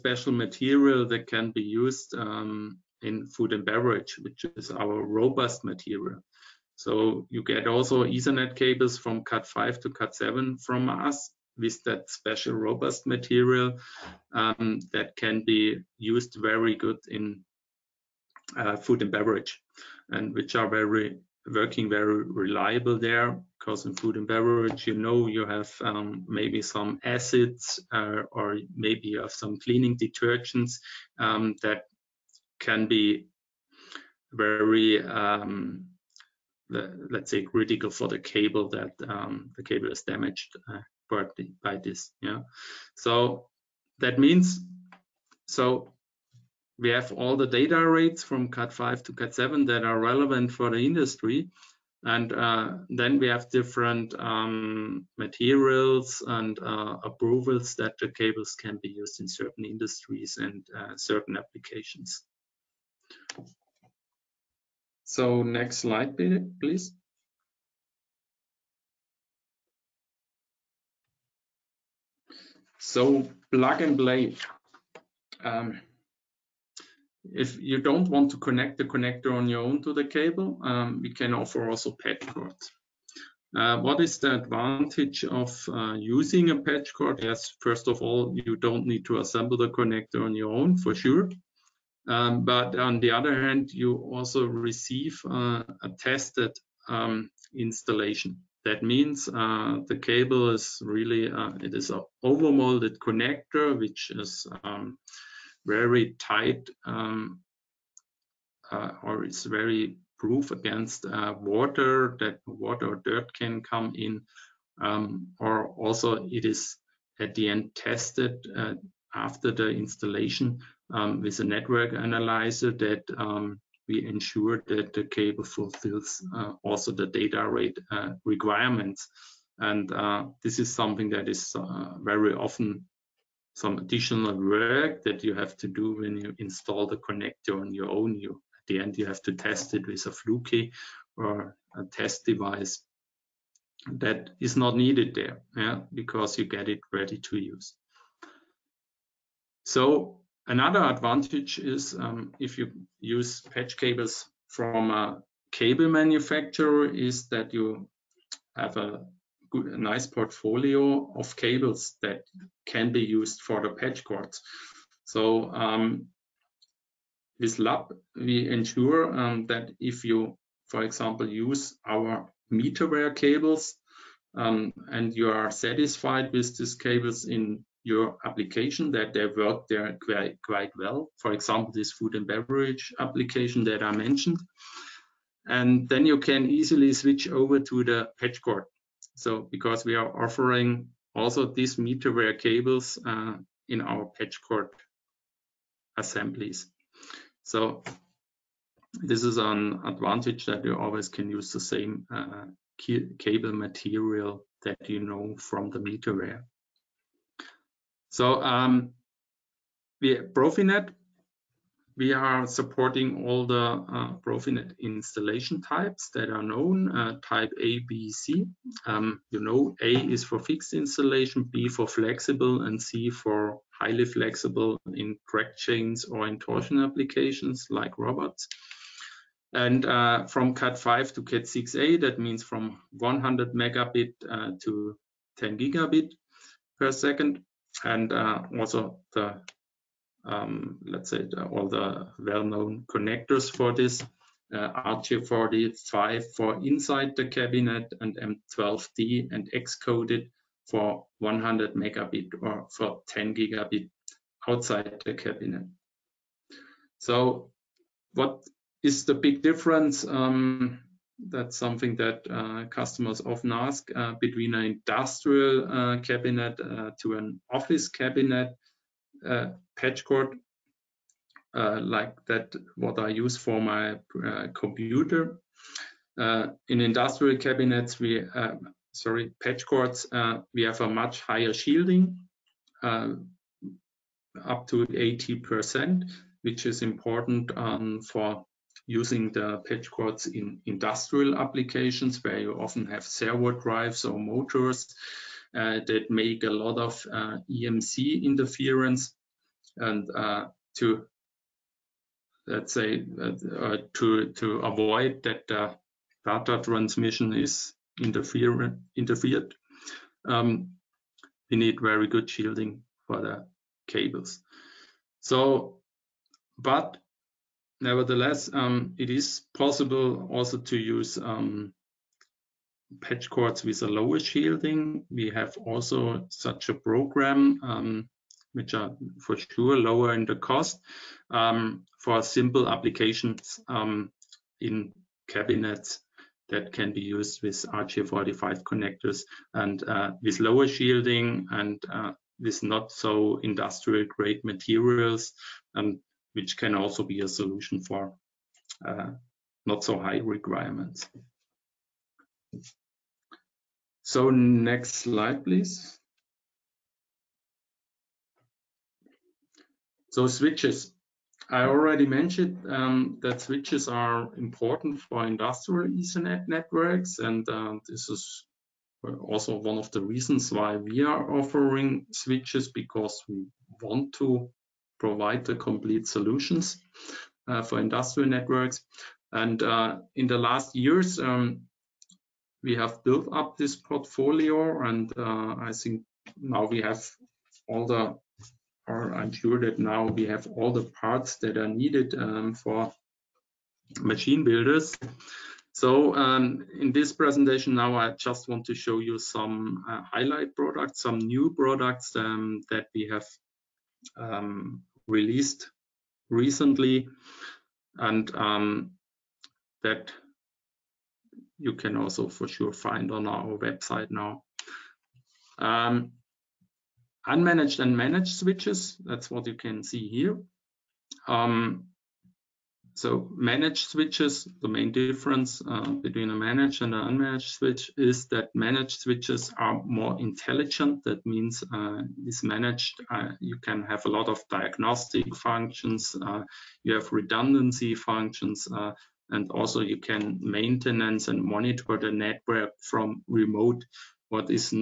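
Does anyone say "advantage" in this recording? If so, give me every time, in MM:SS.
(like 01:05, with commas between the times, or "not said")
01:24, 02:30, 03:19.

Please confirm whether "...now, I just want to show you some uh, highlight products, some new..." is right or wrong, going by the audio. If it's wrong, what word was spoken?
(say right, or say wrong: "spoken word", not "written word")
right.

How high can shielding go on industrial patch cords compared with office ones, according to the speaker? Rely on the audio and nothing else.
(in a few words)
80 percent.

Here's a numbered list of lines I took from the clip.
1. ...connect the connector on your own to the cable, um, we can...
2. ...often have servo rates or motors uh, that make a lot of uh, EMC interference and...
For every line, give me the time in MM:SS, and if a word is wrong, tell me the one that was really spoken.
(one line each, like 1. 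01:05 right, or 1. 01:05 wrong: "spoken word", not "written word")
1. 01:18 right
2. 04:52 wrong: "drives", not "rates".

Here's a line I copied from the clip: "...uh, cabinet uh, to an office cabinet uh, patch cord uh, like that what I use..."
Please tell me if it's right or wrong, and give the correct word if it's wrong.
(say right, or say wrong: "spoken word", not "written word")
right.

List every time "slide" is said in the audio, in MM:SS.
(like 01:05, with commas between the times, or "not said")
01:05, 05:54.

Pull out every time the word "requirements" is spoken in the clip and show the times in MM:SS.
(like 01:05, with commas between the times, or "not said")
02:08, 05:50.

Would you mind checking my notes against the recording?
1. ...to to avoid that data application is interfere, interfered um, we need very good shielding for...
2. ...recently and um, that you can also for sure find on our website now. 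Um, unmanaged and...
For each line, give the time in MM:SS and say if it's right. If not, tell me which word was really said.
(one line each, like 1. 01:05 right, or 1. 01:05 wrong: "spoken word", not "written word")
1. 05:03 wrong: "transmission", not "application"
2. 06:46 right.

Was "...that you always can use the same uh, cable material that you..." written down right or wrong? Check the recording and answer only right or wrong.
right.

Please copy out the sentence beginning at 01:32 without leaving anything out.
Um, but on the other hand, you also receive uh, a tested um, installation.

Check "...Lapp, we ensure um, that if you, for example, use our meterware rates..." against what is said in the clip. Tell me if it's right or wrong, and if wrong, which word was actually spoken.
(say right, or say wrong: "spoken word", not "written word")
wrong: "cables", not "rates".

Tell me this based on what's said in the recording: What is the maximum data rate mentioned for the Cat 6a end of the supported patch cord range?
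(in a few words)
10 gigabit per second.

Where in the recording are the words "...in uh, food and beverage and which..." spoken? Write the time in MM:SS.
00:17.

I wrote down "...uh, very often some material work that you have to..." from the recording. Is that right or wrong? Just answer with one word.
wrong.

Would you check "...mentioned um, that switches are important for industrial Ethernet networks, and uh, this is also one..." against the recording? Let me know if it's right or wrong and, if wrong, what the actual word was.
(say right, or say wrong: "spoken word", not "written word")
right.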